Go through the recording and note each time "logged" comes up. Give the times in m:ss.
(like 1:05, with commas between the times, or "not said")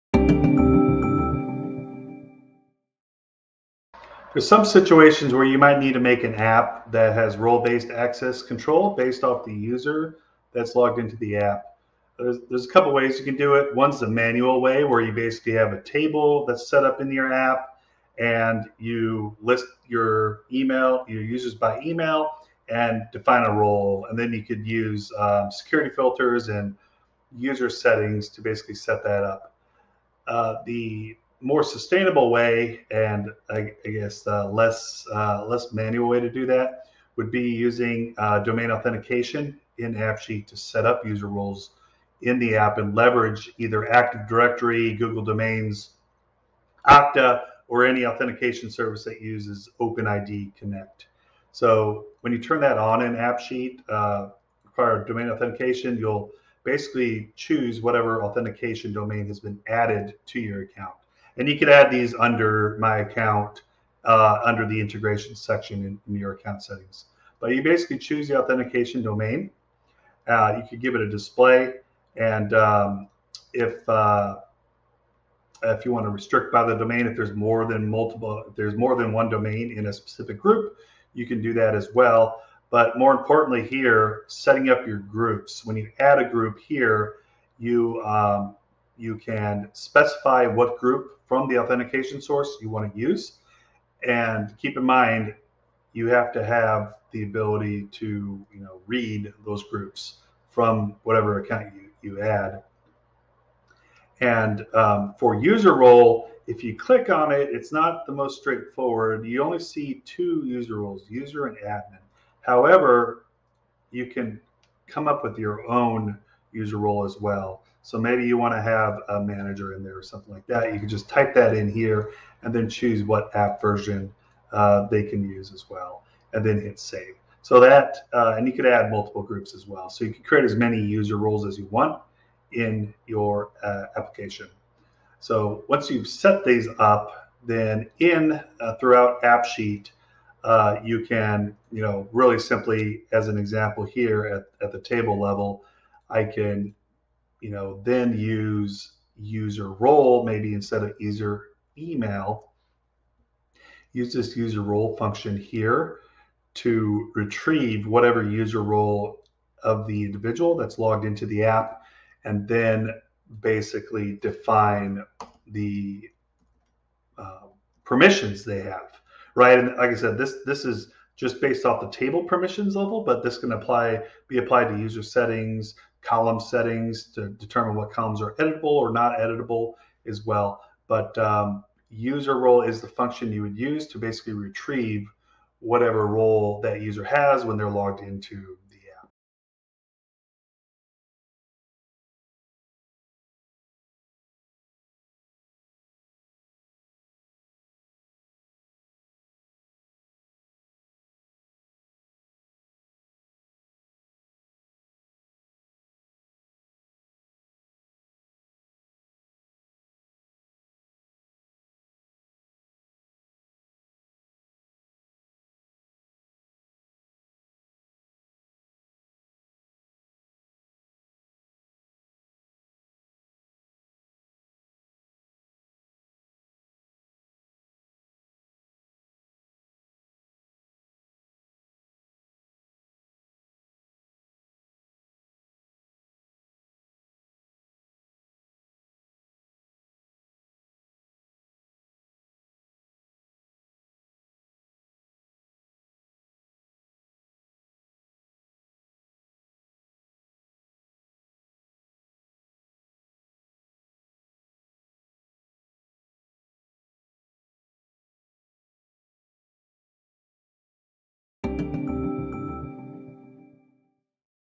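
0:10, 2:40, 3:07.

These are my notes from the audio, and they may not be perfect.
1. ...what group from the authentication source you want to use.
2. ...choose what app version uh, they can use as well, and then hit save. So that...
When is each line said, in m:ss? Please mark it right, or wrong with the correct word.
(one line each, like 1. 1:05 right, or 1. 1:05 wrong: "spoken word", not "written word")
1. 1:30 right
2. 2:02 right.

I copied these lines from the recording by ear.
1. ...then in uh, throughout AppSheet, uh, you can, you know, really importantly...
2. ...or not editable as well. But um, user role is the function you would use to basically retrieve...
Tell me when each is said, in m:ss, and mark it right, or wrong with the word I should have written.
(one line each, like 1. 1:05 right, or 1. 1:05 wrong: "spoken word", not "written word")
1. 2:17 wrong: "simply", not "importantly"
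2. 2:58 right.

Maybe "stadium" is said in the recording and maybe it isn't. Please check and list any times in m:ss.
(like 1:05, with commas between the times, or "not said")
not said.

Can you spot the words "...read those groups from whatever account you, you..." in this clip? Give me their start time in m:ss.
1:38.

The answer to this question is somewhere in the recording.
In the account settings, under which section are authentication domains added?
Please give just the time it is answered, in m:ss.
1:04.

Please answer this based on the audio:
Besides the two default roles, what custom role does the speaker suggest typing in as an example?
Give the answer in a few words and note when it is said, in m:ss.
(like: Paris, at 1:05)
manager, at 1:59.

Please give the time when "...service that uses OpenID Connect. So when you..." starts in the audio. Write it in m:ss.
0:48.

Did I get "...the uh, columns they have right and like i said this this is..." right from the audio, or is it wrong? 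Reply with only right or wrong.
wrong.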